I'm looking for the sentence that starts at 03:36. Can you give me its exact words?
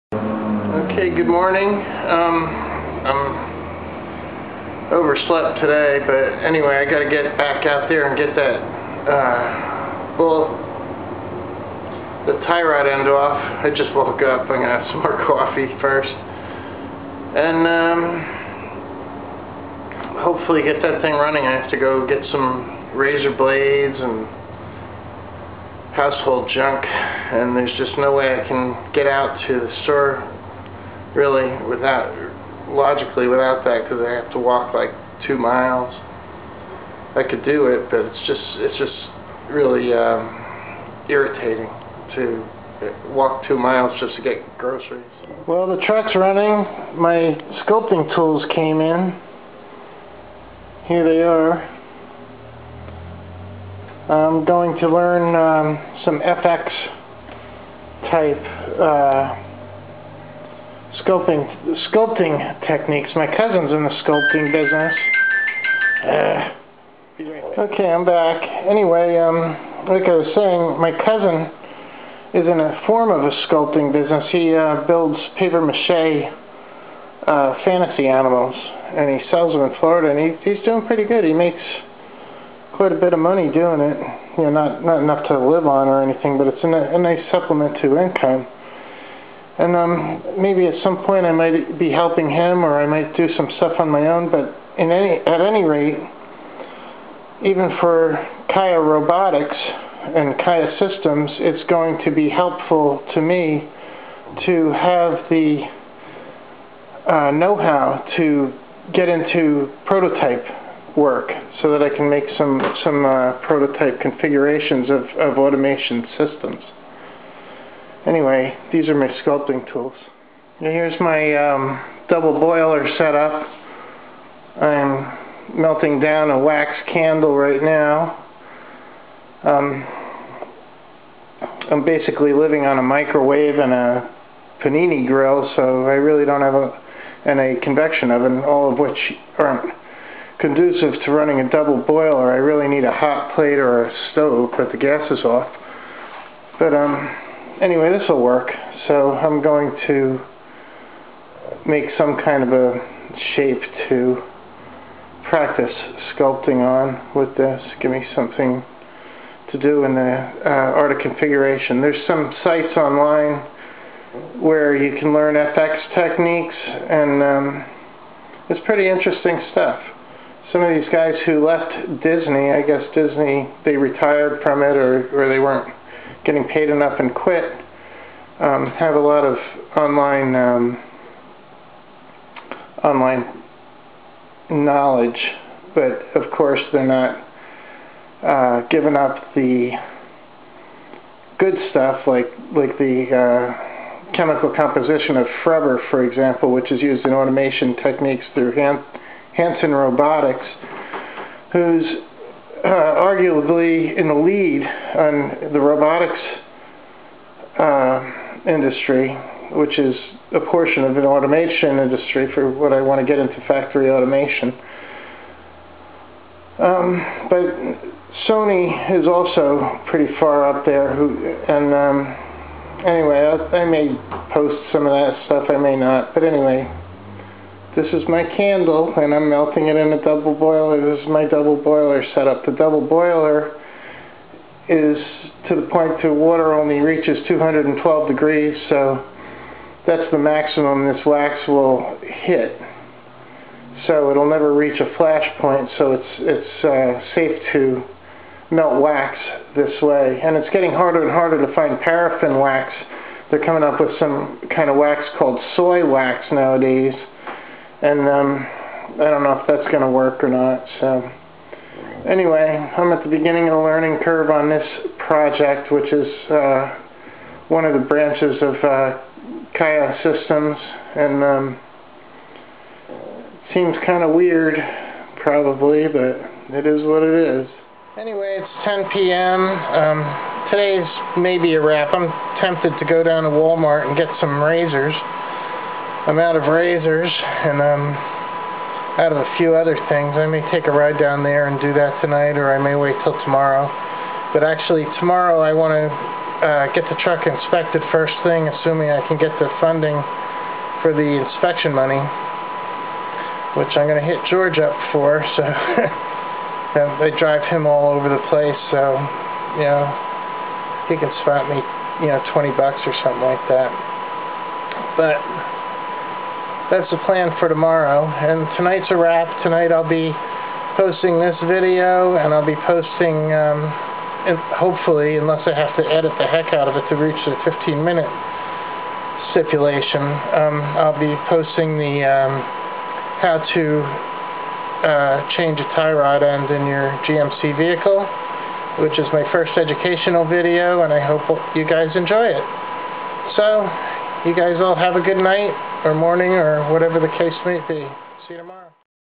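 Um, but Sony is also pretty far up there.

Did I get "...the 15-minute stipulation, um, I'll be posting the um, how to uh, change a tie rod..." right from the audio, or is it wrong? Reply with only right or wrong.
right.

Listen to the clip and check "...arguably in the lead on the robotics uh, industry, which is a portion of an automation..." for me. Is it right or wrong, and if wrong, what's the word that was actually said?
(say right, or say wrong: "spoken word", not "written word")
right.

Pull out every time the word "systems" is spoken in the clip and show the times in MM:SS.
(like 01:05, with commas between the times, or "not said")
01:40, 01:56, 04:30.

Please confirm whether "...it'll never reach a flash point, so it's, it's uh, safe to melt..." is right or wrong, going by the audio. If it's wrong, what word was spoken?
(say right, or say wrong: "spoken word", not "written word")
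right.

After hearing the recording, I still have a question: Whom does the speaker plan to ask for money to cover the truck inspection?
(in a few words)
George.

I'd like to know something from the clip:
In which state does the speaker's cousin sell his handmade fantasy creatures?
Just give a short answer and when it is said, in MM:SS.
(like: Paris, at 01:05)
Florida, at 01:19.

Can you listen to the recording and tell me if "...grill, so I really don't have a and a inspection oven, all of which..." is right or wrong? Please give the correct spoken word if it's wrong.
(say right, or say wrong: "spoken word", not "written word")
wrong: "convection", not "inspection".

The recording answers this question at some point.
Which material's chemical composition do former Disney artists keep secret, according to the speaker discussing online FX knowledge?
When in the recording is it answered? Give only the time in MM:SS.
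03:15.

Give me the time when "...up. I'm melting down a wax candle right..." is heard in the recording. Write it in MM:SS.
02:03.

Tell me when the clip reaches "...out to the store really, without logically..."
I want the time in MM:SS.
00:29.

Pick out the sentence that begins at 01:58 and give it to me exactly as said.
Anyway, these are my sculpting tools.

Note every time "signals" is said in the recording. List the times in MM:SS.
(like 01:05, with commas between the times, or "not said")
not said.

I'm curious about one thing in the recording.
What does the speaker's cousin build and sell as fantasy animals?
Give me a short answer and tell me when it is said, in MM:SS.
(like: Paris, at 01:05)
paper mache, at 01:15.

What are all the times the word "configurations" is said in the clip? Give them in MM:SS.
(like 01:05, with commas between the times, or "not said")
01:53, 02:40.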